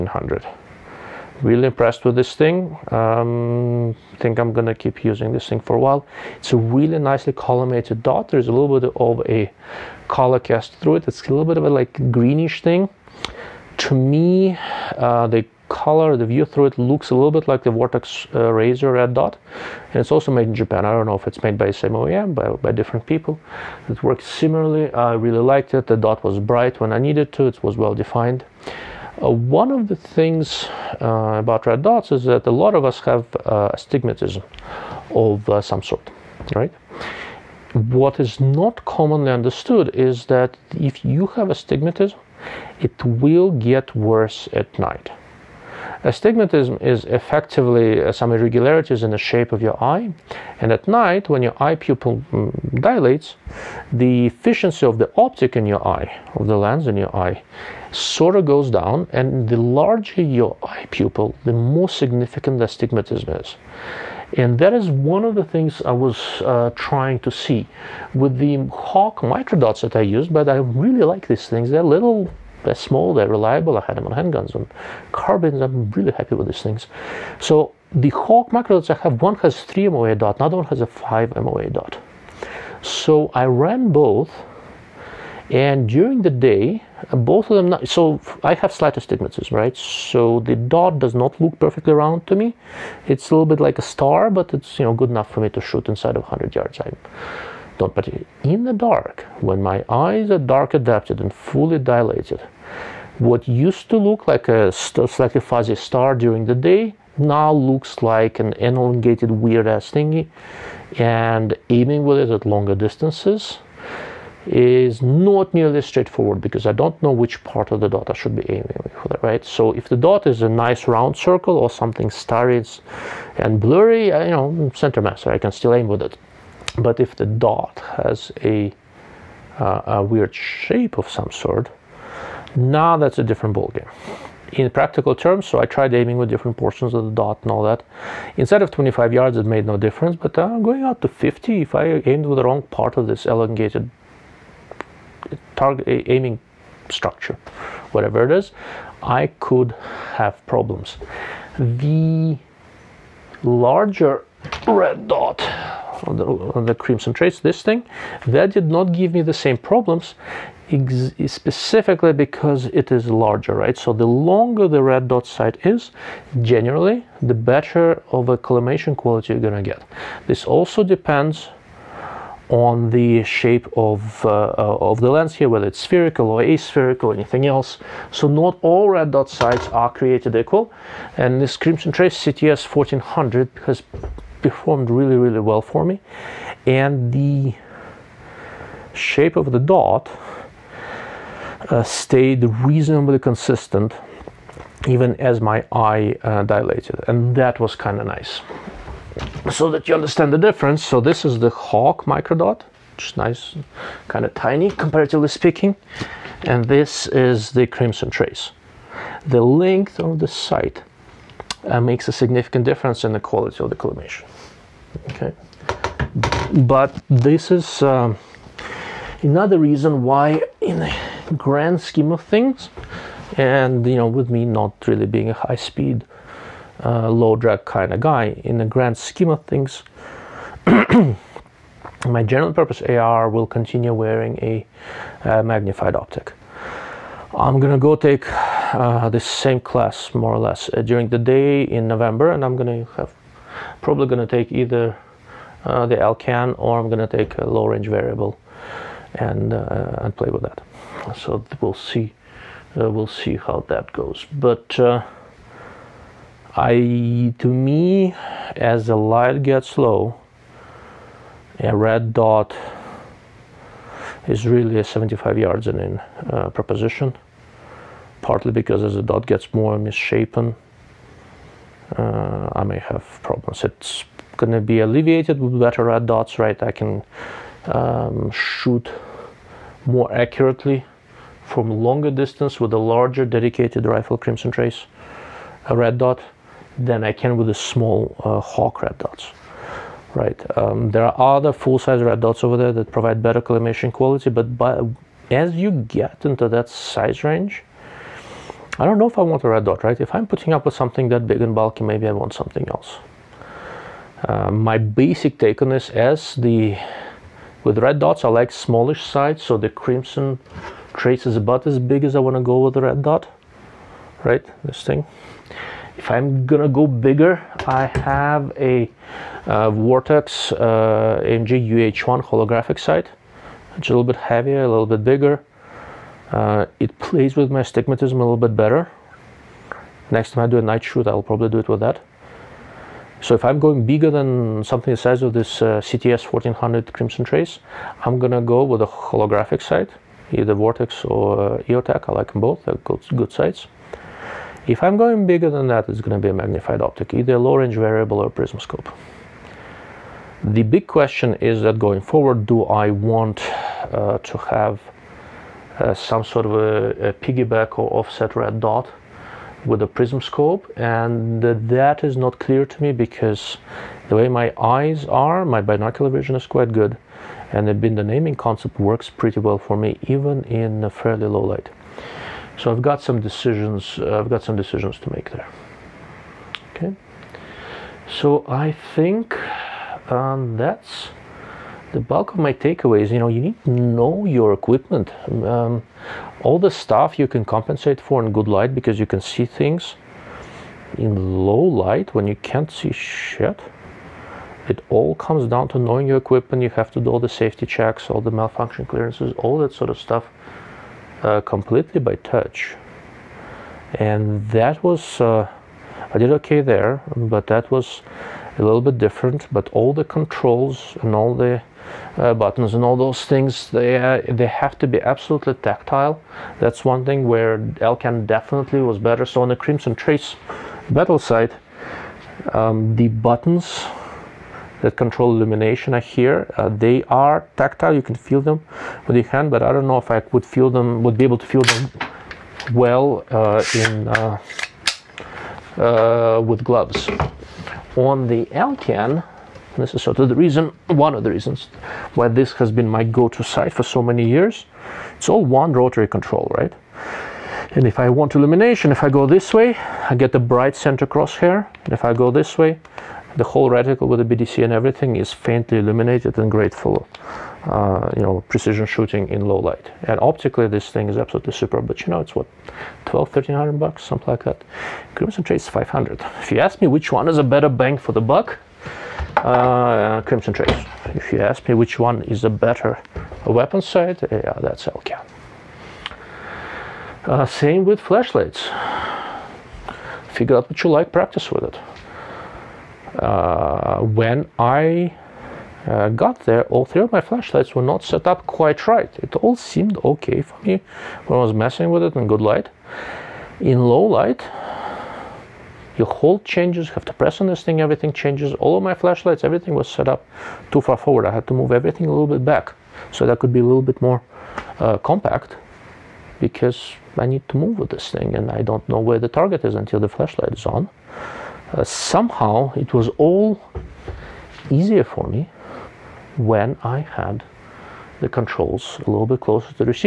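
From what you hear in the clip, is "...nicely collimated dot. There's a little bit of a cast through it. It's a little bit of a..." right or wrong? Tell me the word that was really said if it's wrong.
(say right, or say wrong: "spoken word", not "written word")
right.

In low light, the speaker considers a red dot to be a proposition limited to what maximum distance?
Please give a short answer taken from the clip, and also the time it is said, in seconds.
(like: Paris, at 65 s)
75 yards, at 264 s.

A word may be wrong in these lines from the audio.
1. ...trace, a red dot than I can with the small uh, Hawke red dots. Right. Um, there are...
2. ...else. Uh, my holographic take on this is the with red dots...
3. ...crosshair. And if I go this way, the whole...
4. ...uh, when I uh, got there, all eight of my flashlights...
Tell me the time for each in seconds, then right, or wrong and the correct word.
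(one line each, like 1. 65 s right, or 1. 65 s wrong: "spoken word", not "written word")
1. 284 s right
2. 302 s wrong: "basic", not "holographic"
3. 451 s right
4. 483 s wrong: "three", not "eight".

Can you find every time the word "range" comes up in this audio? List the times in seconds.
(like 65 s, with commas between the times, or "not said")
247 s, 297 s, 347 s.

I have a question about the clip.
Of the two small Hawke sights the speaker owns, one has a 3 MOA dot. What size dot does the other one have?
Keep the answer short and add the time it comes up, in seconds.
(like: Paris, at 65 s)
5 MOA, at 80 s.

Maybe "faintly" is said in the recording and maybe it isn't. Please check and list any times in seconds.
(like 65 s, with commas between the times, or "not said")
455 s.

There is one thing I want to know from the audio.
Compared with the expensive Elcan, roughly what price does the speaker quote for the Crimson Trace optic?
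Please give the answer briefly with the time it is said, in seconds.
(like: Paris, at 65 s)
500, at 465 s.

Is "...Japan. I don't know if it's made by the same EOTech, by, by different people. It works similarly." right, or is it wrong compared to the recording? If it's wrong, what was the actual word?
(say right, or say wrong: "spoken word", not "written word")
wrong: "OEM", not "EOTech".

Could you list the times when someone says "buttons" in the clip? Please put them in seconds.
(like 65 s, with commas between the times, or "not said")
412 s, 423 s.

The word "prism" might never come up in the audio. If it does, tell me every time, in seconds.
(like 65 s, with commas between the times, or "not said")
348 s, 359 s.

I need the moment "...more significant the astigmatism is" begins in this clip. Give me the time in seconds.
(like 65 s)
61 s.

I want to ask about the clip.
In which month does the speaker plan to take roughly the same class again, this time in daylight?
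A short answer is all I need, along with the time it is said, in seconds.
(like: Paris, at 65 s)
November, at 241 s.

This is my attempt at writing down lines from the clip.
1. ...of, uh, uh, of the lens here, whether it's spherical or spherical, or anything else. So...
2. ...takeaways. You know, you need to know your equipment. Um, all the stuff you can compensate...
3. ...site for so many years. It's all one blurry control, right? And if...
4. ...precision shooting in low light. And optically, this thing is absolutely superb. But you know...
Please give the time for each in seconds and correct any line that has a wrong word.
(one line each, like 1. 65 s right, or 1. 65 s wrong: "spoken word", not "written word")
1. 173 s wrong: "aspherical", not "spherical"
2. 382 s right
3. 443 s wrong: "rotary", not "blurry"
4. 458 s right.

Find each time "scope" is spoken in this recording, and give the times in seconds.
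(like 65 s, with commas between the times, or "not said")
348 s, 360 s.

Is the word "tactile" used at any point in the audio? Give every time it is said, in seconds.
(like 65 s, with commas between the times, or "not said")
415 s, 427 s.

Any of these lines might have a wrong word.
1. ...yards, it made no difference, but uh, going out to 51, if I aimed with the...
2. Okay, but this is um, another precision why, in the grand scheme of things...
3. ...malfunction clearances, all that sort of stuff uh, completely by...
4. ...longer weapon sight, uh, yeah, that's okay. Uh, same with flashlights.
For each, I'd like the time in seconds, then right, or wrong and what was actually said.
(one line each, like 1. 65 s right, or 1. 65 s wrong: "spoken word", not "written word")
1. 139 s wrong: "50", not "51"
2. 215 s wrong: "reason", not "precision"
3. 398 s right
4. 472 s wrong: "better", not "longer".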